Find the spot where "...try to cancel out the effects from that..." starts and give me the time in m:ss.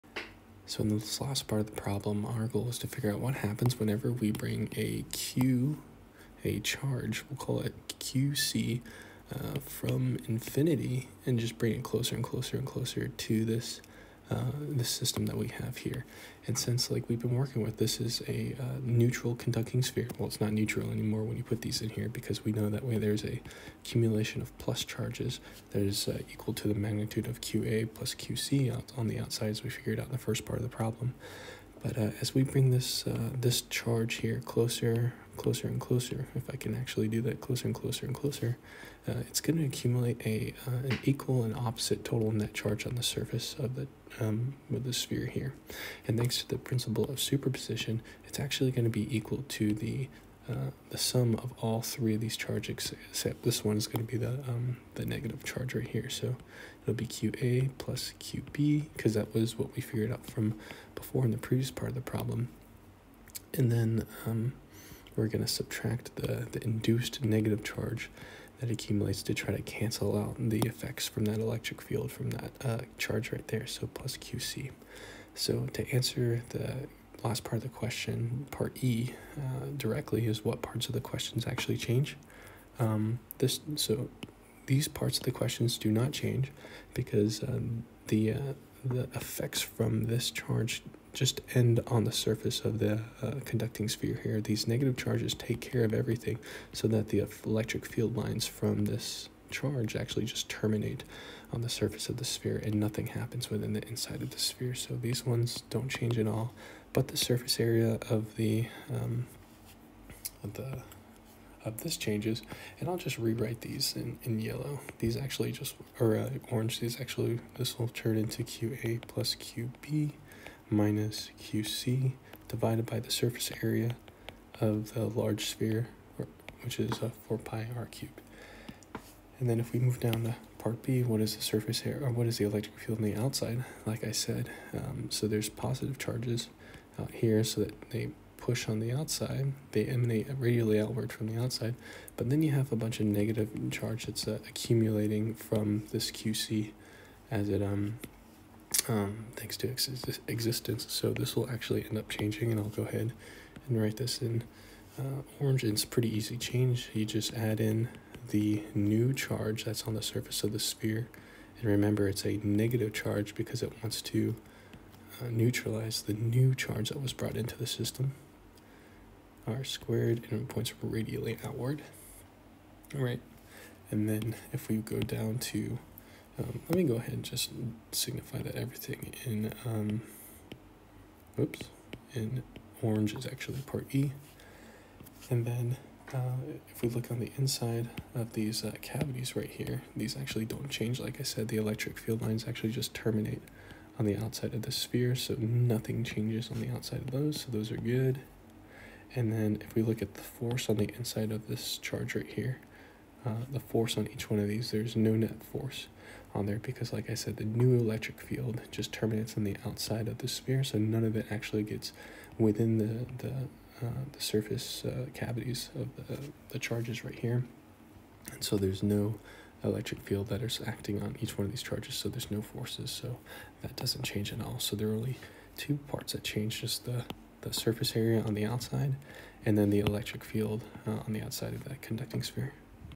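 1:09.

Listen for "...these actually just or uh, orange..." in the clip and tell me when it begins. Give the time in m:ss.
1:54.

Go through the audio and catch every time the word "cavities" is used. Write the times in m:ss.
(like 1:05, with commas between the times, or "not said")
3:08, 3:35.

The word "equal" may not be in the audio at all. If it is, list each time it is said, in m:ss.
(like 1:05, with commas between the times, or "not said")
0:26, 0:41, 0:49.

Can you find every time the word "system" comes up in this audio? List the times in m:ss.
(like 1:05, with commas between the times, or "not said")
0:14, 2:47.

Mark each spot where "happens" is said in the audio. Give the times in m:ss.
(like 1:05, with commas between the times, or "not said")
0:03, 1:43.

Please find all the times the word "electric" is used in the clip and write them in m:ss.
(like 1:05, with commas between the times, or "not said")
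1:11, 1:37, 2:12, 3:11, 3:27, 3:39, 3:49.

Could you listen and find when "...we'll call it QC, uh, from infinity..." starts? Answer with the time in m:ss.
0:07.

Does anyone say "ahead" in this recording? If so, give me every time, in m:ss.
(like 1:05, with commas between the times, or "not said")
2:32, 2:56.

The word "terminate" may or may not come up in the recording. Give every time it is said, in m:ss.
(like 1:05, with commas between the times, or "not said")
1:40, 3:12, 3:28.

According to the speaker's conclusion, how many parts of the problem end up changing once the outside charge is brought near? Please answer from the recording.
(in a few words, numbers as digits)
2.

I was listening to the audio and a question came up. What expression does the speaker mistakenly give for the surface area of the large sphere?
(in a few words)
4 pi r cubed.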